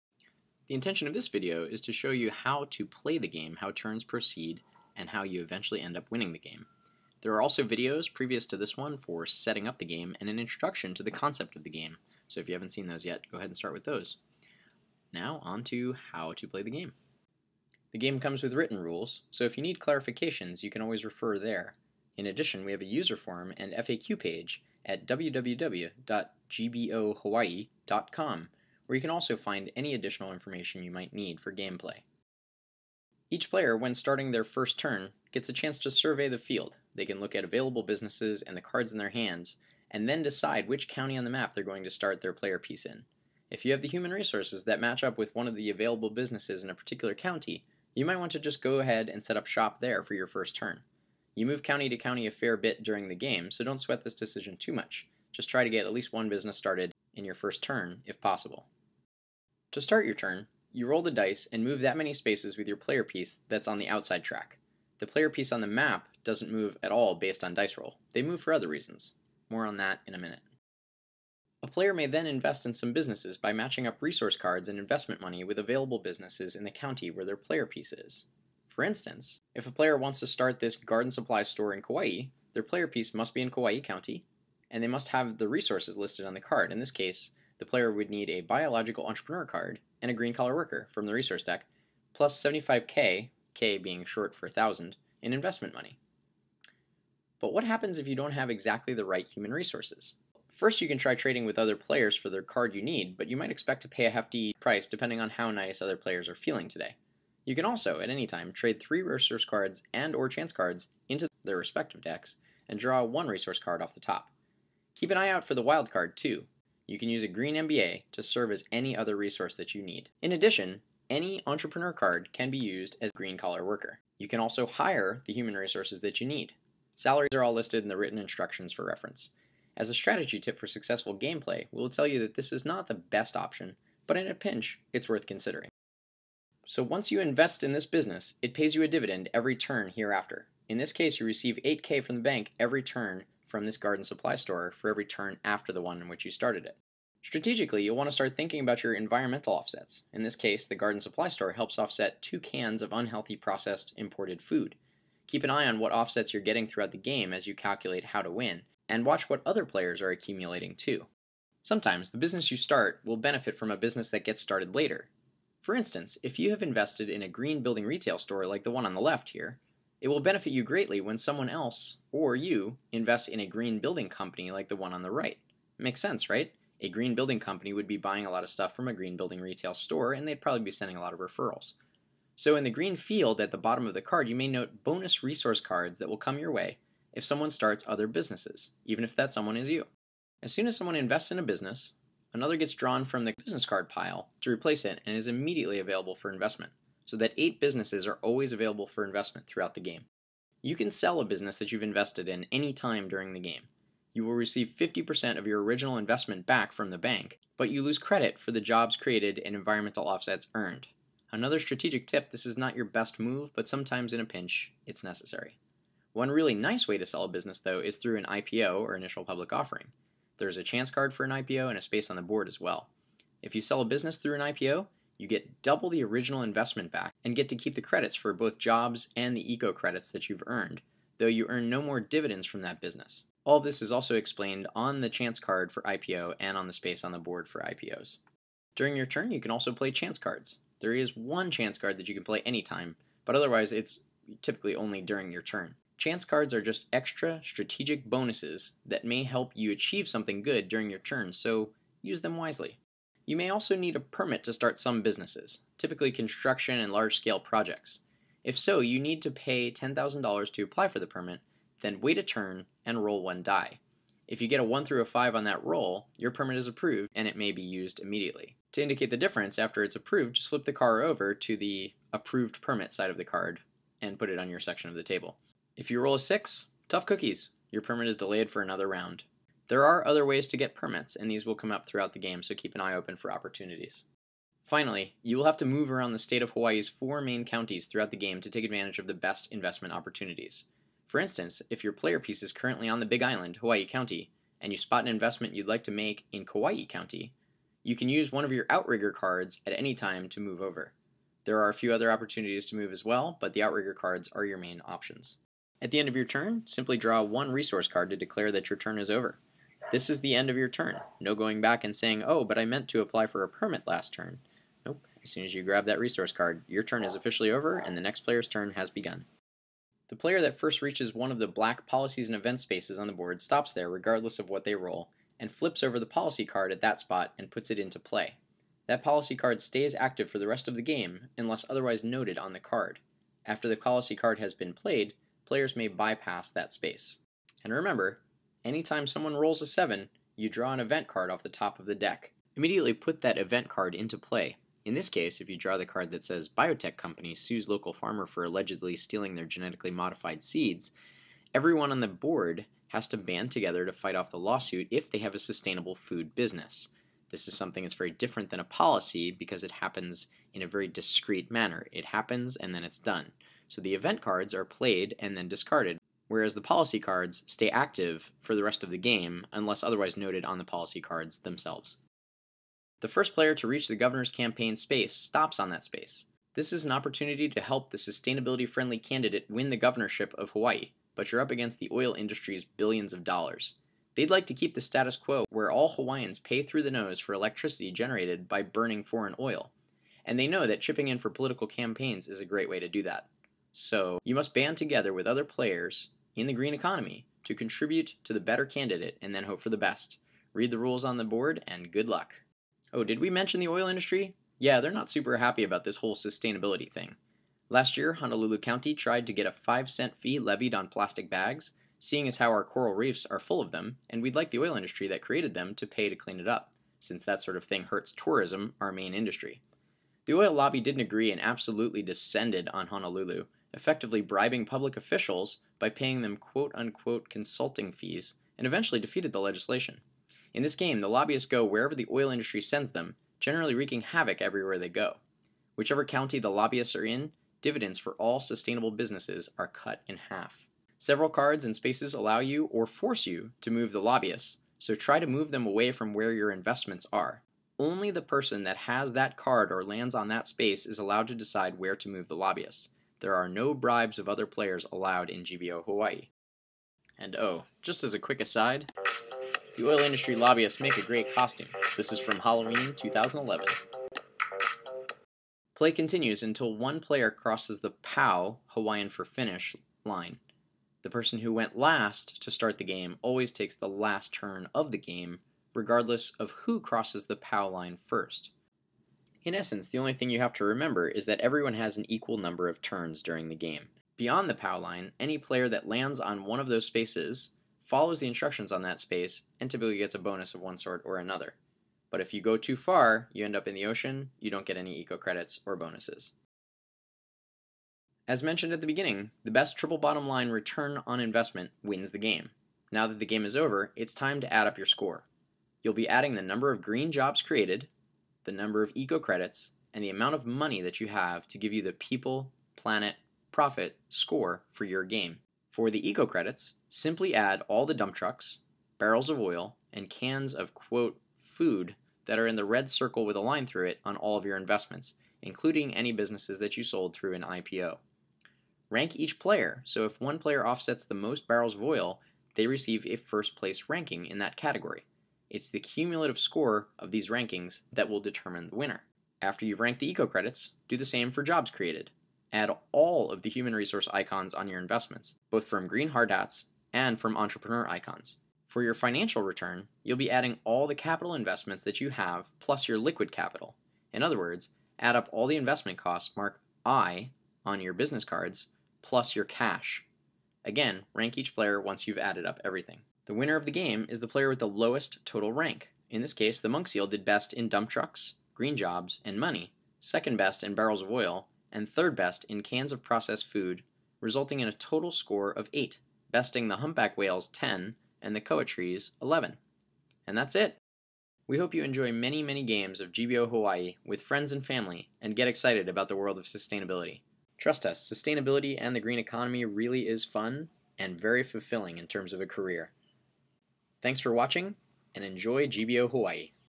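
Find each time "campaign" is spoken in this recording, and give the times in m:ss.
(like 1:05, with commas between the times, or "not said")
6:14, 6:31.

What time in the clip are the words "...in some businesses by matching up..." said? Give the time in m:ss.
1:12.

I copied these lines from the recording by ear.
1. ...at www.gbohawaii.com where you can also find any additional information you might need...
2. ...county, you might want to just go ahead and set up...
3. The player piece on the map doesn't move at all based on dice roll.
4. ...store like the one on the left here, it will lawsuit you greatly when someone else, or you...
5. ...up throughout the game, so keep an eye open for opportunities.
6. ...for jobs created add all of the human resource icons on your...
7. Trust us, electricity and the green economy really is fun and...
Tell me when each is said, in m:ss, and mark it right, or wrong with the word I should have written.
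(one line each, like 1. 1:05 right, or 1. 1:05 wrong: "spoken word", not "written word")
1. 0:24 right
2. 0:47 right
3. 1:04 right
4. 2:48 wrong: "benefit", not "lawsuit"
5. 4:41 right
6. 9:01 right
7. 9:47 wrong: "sustainability", not "electricity".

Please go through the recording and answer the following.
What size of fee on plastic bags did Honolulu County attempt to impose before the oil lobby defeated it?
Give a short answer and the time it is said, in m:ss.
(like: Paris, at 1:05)
5 cent, at 6:49.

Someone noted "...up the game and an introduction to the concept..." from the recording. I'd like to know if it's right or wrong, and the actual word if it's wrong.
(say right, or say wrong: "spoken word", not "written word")
right.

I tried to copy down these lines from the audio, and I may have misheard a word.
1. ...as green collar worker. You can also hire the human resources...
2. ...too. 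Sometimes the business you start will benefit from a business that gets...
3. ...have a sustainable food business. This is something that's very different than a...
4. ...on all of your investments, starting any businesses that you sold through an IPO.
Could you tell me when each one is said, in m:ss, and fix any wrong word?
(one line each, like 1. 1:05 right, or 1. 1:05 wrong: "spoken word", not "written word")
1. 2:03 right
2. 2:40 right
3. 5:55 right
4. 8:44 wrong: "including", not "starting".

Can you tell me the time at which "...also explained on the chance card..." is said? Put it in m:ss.
3:53.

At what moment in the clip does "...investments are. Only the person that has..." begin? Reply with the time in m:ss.
7:26.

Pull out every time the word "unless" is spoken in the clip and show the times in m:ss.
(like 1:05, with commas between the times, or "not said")
5:31, 6:09.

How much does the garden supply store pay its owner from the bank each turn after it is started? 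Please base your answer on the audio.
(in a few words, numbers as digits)
8K.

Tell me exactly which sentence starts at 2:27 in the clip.
Strategically, you'll want to start thinking about your environmental offsets.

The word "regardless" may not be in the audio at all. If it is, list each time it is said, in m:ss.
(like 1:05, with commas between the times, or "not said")
5:23, 7:55.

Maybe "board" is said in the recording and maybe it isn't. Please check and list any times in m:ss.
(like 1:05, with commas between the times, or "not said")
3:42, 3:57, 5:23, 5:52, 6:41.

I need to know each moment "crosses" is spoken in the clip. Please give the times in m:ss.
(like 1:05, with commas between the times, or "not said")
7:47, 7:56.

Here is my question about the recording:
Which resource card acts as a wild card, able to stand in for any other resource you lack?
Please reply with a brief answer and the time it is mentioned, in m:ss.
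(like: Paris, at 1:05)
green MBA, at 1:57.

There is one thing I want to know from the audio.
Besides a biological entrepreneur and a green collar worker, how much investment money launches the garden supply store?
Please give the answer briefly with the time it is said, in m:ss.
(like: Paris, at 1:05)
75k, at 1:32.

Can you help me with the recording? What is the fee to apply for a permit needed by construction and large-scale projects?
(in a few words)
$10,000.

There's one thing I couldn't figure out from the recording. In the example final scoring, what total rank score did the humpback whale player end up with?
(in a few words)
10.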